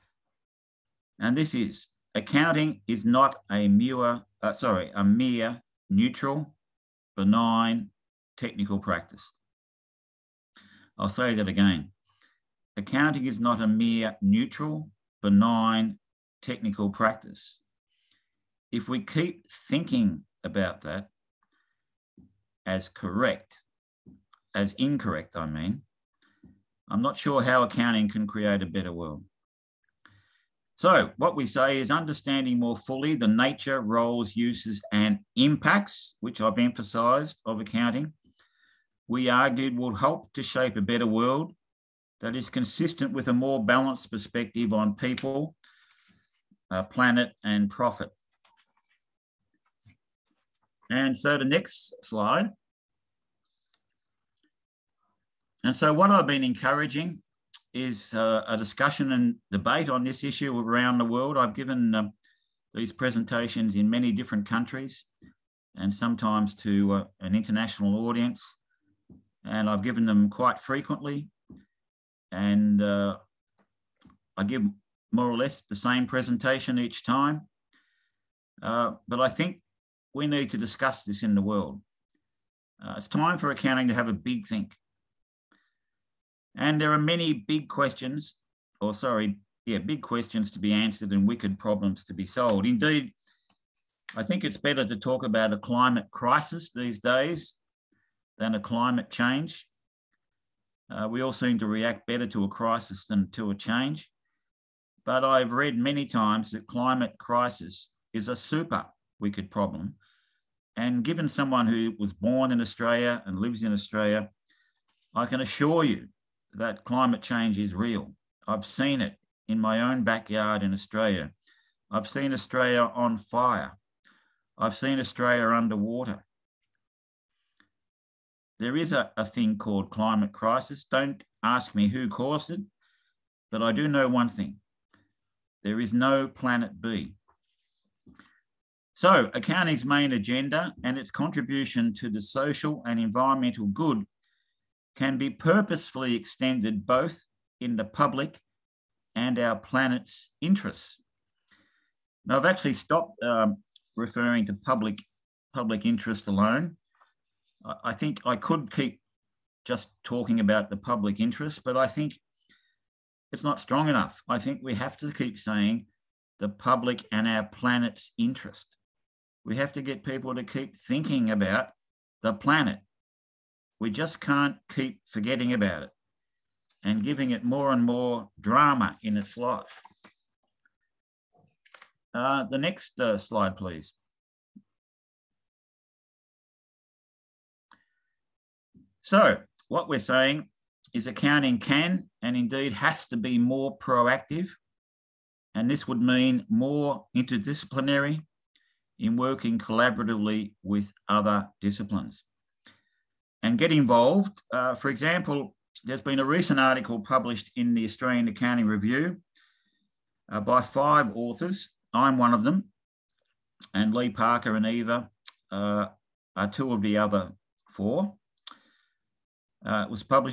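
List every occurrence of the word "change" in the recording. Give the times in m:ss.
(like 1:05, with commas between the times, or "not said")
1:39, 1:43, 1:57.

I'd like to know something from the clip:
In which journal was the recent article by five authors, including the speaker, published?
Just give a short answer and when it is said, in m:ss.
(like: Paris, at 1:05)
Australian Accounting Review, at 3:27.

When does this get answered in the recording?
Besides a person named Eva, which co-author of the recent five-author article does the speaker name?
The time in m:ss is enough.
3:33.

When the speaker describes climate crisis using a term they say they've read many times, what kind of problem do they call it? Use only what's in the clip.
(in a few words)
super wicked problem.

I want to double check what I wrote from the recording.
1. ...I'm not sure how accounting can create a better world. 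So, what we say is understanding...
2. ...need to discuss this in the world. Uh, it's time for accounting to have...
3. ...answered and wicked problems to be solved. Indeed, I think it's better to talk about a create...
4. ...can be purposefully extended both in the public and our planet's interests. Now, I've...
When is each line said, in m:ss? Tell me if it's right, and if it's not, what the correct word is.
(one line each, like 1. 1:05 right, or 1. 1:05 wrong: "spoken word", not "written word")
1. 0:26 right
2. 1:20 right
3. 1:30 wrong: "climate", not "create"
4. 2:24 right.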